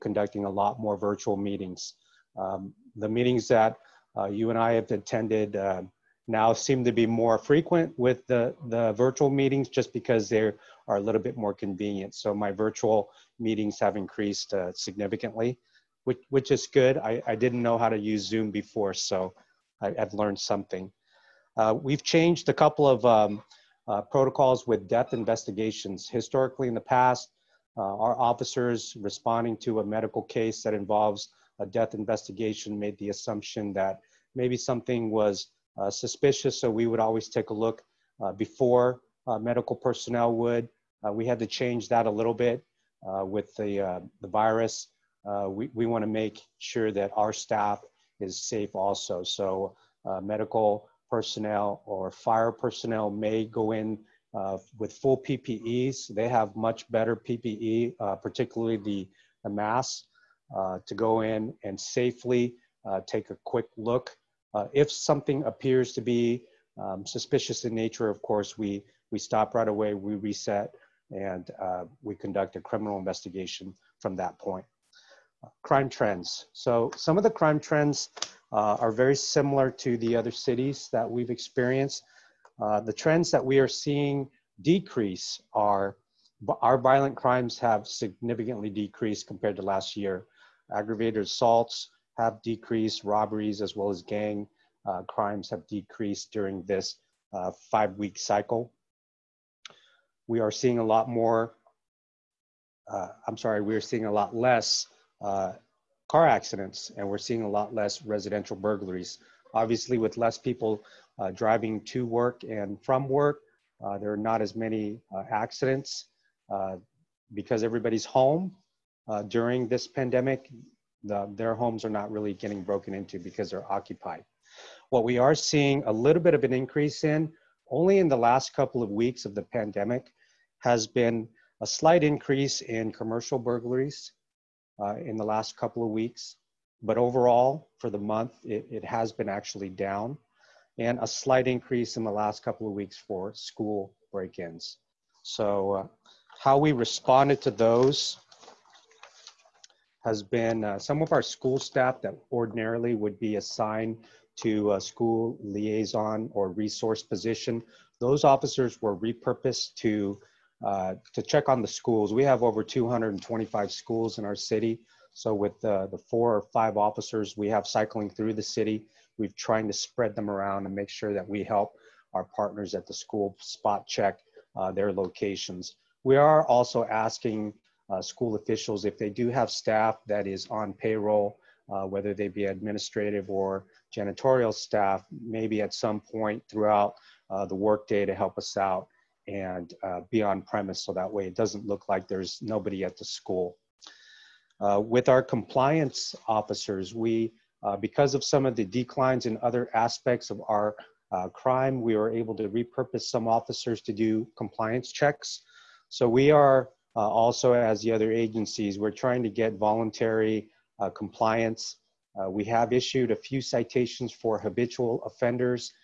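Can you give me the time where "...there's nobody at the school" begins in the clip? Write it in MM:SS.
03:12.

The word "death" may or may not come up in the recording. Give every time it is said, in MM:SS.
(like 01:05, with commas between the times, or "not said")
00:24, 00:31.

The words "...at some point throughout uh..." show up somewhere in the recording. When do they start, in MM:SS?
03:05.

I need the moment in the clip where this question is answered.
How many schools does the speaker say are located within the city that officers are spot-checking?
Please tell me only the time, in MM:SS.
02:42.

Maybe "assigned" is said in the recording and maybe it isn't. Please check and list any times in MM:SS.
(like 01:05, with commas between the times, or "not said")
02:33.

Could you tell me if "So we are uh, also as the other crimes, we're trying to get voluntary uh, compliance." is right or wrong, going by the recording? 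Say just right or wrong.
wrong.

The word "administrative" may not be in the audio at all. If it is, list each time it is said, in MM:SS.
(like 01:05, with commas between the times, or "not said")
03:02.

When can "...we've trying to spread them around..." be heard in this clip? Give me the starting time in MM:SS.
02:49.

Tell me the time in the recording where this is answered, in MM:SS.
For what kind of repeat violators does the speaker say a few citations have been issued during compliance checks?
03:34.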